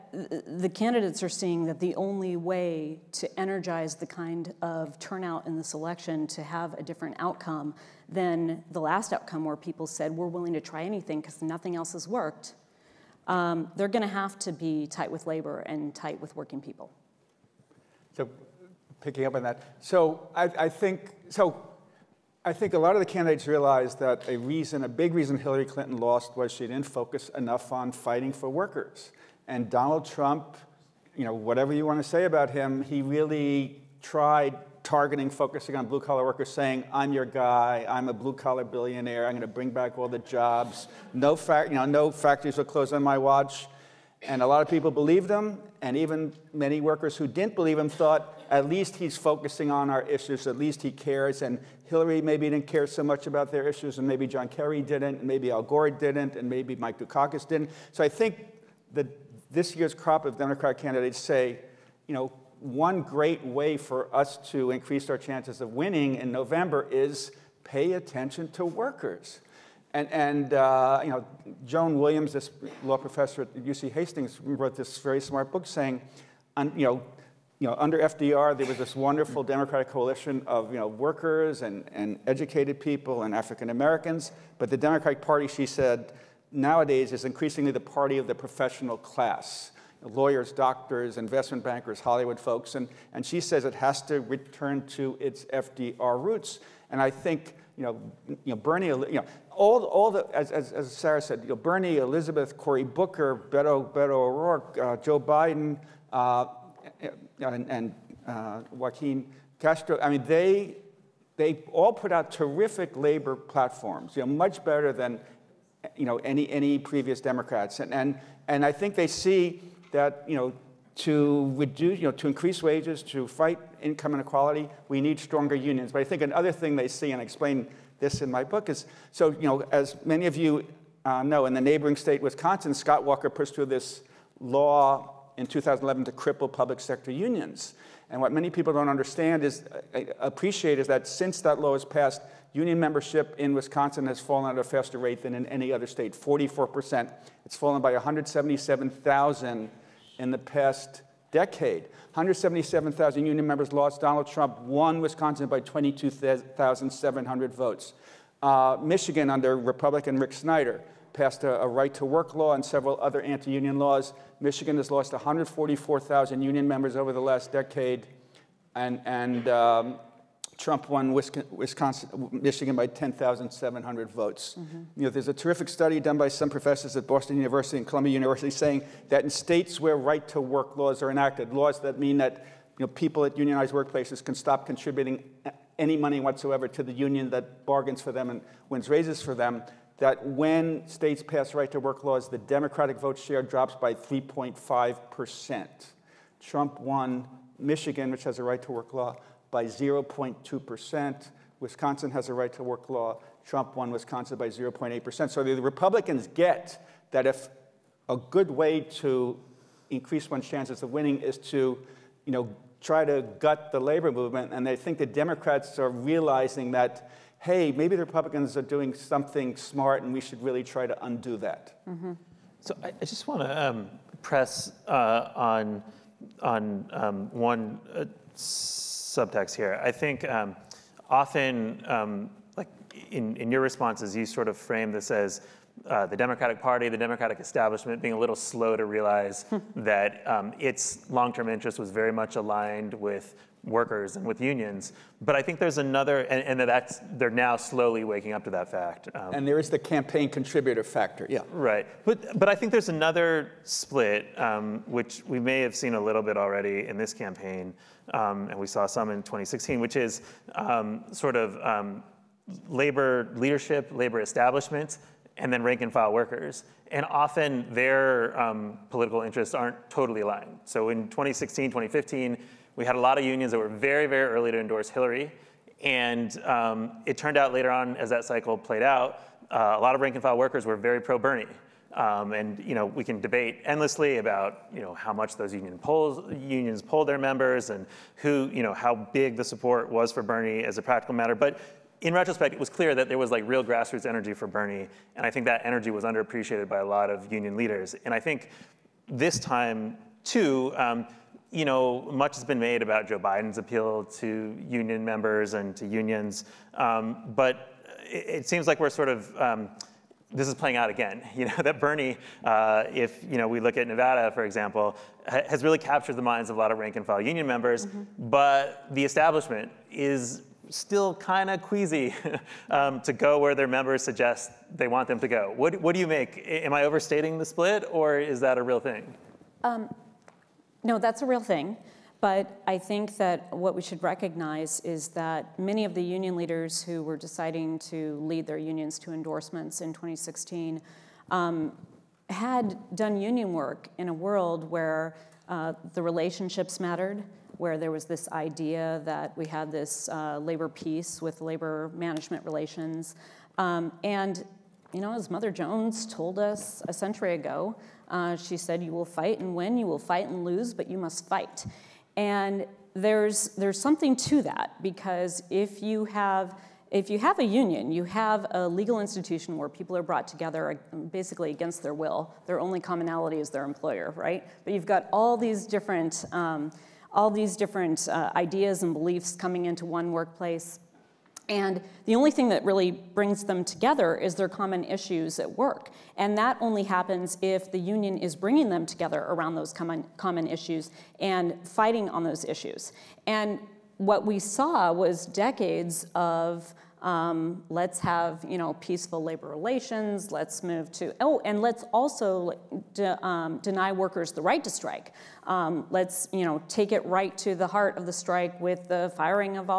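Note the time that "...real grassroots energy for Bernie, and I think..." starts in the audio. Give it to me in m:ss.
4:53.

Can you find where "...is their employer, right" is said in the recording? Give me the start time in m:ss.
6:13.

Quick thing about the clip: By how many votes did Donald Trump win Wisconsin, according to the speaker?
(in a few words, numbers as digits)
22,700.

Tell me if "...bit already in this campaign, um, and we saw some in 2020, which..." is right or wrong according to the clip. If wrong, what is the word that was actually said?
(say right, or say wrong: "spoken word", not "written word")
wrong: "2016", not "2020".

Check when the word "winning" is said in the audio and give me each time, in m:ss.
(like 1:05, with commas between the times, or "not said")
1:05, 3:30.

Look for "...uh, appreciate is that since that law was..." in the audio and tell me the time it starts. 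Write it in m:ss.
2:19.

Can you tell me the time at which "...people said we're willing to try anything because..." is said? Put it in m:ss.
0:09.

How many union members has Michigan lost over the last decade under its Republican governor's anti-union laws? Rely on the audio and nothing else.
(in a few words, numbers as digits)
144,000.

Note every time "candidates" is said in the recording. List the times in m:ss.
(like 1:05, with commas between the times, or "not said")
0:00, 0:23, 1:00.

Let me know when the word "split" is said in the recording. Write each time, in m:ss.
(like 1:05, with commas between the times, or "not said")
4:13, 5:27.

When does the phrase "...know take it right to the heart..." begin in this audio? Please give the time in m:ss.
6:46.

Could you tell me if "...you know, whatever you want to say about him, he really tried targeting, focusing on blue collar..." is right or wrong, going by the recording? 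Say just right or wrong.
right.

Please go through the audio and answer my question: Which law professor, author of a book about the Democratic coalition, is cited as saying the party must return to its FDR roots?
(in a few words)
Joan Williams.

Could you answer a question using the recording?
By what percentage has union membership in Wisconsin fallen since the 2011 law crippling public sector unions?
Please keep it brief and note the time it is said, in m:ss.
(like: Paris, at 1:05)
44%, at 2:26.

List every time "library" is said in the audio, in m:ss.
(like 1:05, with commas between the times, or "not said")
not said.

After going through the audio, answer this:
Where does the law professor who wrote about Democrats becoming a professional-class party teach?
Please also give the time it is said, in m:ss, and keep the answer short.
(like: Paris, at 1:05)
UC Hastings, at 1:13.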